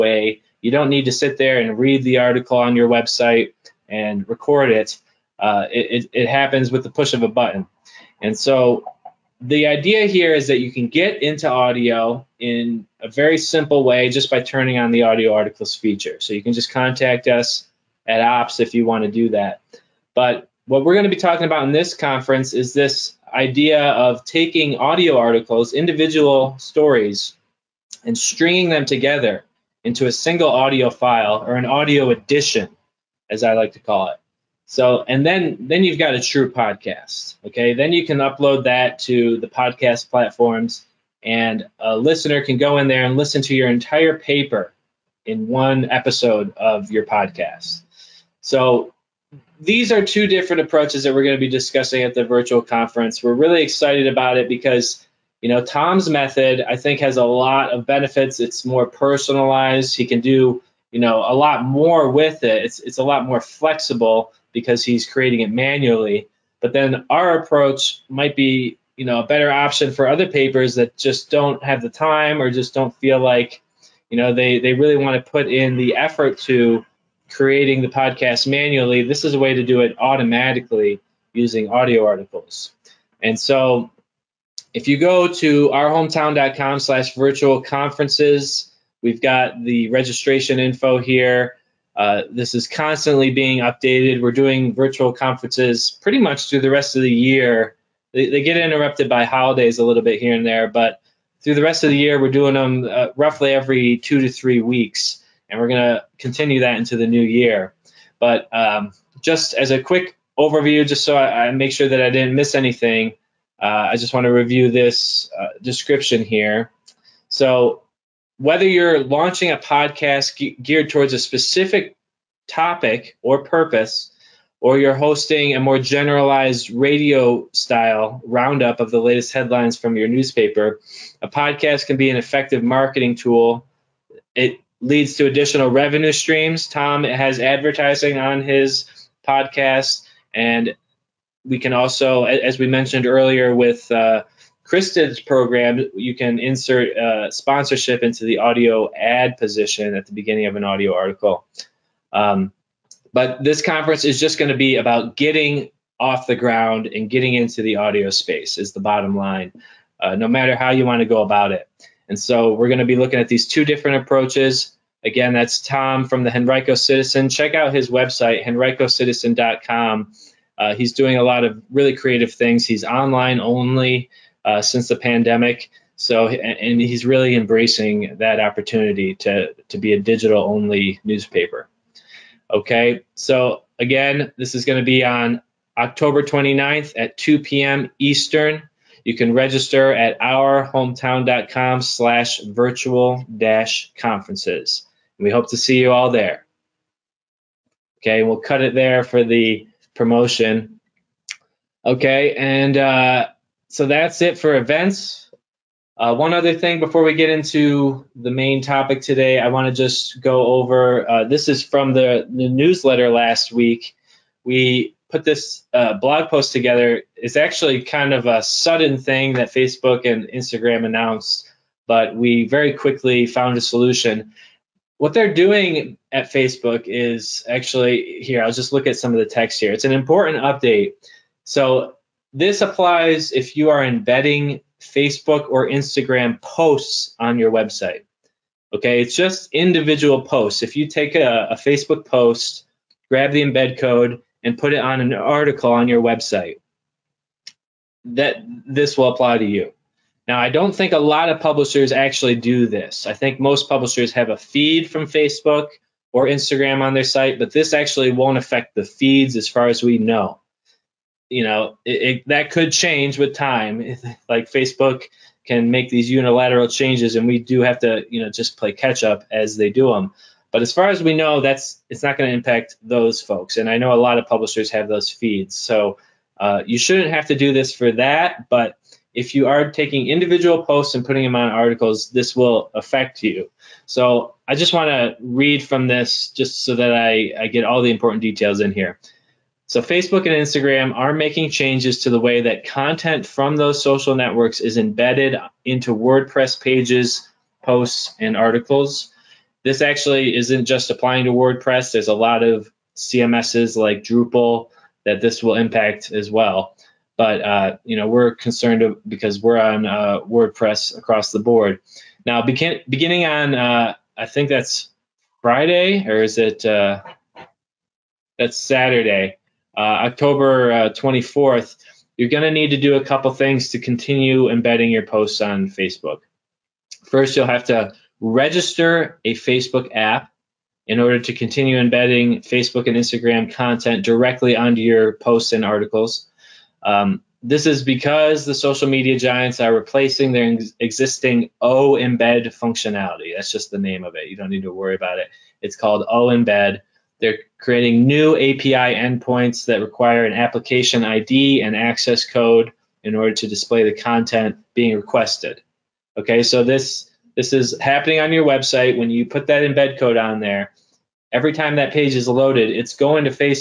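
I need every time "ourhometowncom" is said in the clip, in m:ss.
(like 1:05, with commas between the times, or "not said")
1:25, 3:10.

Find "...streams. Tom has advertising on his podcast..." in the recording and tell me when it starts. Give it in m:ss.
2:16.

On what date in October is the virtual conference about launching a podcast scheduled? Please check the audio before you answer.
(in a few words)
October 29.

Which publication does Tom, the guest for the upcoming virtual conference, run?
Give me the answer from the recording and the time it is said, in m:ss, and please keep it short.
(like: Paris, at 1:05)
Henrico Citizen, at 2:46.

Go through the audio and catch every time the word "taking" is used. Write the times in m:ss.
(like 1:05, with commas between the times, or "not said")
0:24, 4:39.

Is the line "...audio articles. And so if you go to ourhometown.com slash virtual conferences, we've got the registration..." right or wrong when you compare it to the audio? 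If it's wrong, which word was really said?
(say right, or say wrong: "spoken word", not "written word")
right.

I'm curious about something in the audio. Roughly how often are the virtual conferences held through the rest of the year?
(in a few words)
Every 2 to 3 weeks.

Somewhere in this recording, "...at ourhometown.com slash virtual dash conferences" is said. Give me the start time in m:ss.
3:09.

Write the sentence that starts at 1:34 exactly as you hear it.
We're doing virtual conferences pretty much through the rest of the year.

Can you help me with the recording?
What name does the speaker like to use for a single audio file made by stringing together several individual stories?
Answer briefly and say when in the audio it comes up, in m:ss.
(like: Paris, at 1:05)
Audio edition, at 0:31.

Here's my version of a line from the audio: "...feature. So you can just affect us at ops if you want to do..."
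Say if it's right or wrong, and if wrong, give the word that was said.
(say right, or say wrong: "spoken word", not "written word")
wrong: "contact", not "affect".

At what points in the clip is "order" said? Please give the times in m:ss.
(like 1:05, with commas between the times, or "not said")
5:30, 5:53.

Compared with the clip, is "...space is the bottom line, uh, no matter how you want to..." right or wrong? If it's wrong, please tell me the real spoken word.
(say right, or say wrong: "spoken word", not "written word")
right.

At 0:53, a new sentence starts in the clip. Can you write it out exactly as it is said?
We're really excited about it because you know Tom's method I think has a lot of benefits.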